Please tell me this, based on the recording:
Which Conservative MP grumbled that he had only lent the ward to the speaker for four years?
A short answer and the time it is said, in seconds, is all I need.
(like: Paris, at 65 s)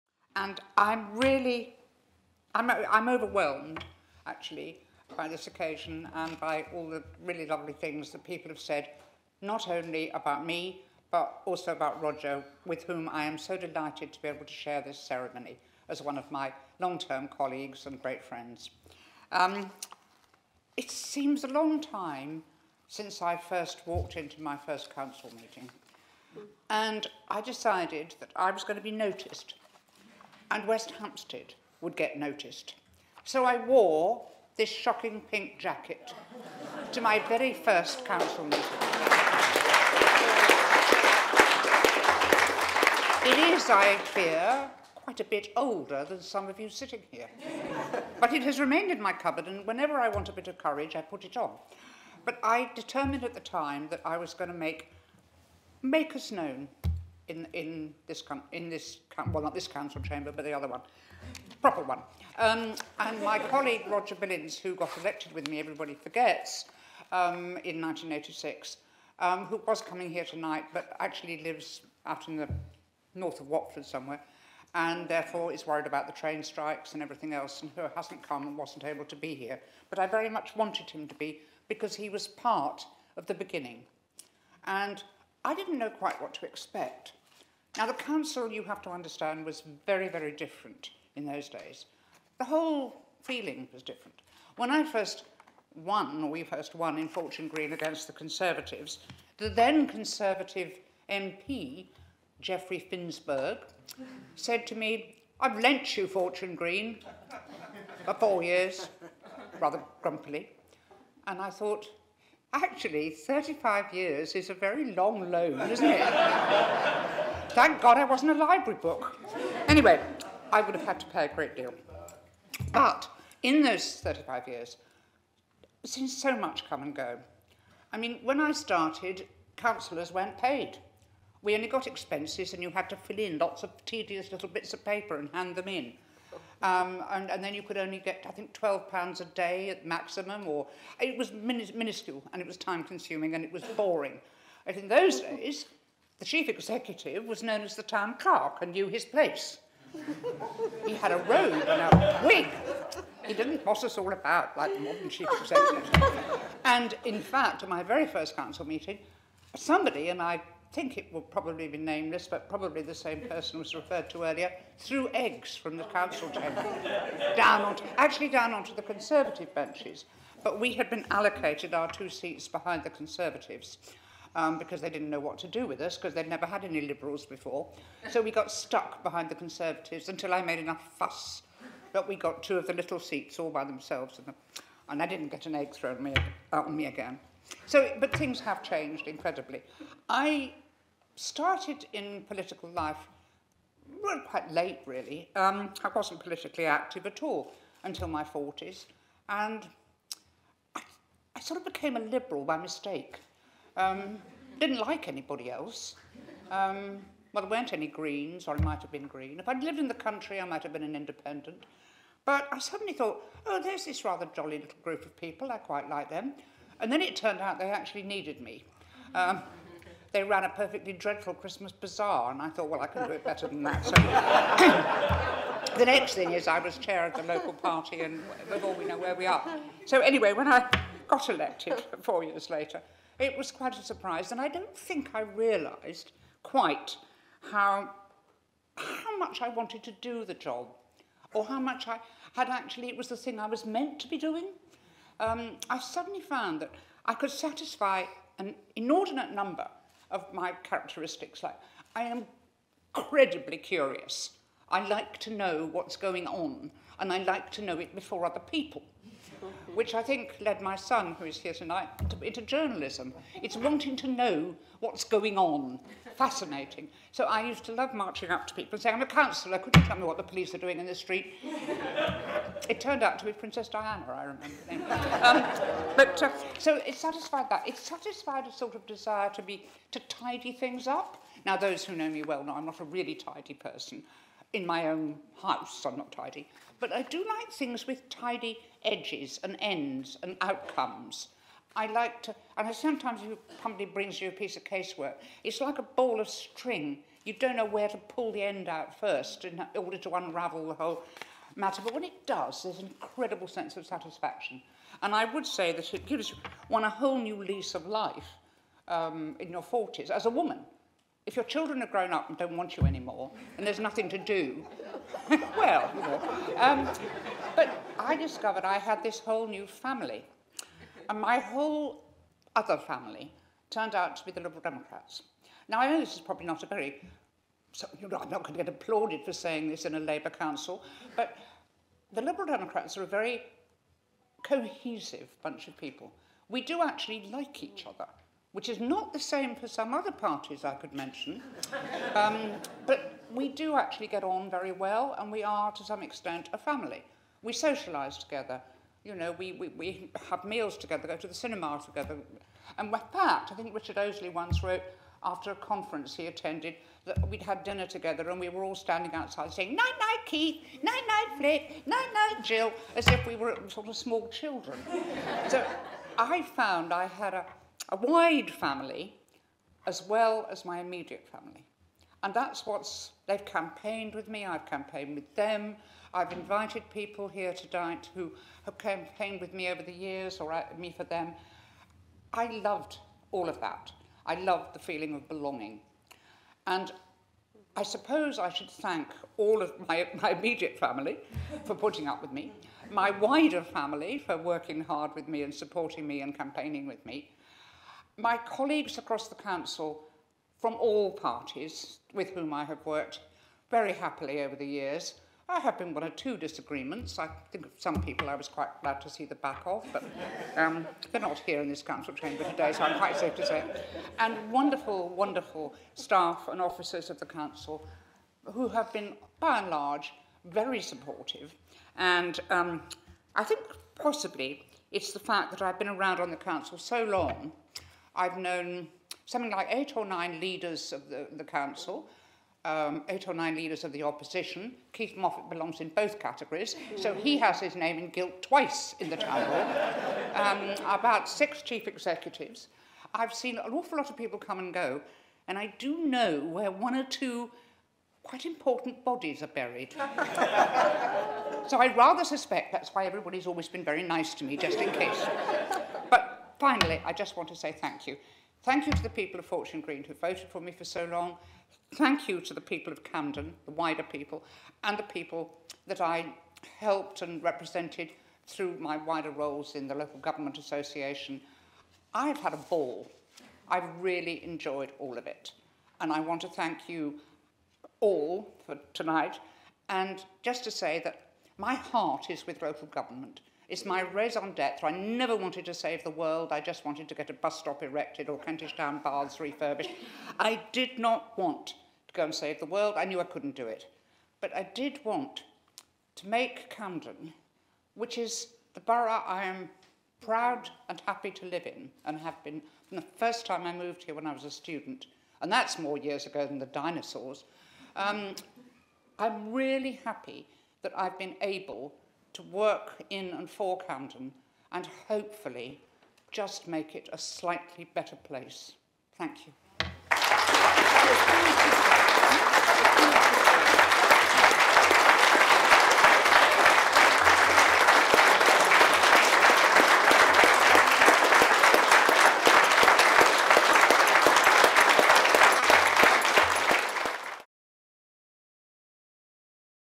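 Geoffrey Finsberg, at 102 s.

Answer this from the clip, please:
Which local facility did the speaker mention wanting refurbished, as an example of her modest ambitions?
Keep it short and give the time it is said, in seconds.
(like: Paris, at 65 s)
Kentish Town baths, at 488 s.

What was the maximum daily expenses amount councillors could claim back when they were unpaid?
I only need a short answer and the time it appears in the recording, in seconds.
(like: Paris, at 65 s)
£12, at 138 s.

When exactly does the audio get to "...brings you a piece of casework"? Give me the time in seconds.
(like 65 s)
293 s.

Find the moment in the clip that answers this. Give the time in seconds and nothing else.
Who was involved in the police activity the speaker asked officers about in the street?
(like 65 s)
273 s.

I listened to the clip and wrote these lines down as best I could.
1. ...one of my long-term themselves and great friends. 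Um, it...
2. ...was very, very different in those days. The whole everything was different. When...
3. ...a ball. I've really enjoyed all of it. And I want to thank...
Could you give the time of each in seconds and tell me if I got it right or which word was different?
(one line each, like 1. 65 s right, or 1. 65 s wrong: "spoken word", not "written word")
1. 16 s wrong: "colleagues", not "themselves"
2. 89 s wrong: "feeling", not "everything"
3. 472 s right.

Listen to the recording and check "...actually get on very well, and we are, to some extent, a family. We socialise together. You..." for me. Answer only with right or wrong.
right.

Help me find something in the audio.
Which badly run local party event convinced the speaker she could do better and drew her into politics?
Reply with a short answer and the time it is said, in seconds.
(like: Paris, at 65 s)
Christmas bazaar, at 221 s.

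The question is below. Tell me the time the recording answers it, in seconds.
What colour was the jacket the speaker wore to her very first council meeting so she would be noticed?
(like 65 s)
34 s.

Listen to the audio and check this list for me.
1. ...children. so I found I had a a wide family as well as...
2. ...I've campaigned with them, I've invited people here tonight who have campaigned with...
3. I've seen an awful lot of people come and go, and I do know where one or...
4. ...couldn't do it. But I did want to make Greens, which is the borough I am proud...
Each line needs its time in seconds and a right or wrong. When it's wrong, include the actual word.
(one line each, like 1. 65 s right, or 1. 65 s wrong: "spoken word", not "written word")
1. 364 s right
2. 374 s right
3. 443 s right
4. 493 s wrong: "Camden", not "Greens".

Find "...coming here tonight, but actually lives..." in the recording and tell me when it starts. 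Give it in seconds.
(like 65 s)
69 s.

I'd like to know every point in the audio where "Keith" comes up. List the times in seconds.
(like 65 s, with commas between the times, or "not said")
360 s, 434 s.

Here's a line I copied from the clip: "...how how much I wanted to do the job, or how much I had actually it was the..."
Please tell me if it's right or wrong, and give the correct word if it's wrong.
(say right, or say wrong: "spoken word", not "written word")
right.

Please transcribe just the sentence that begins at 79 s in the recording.
But I very much wanted him to be, because he was part of the beginning.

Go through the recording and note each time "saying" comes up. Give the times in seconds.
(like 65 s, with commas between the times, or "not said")
268 s, 329 s, 359 s.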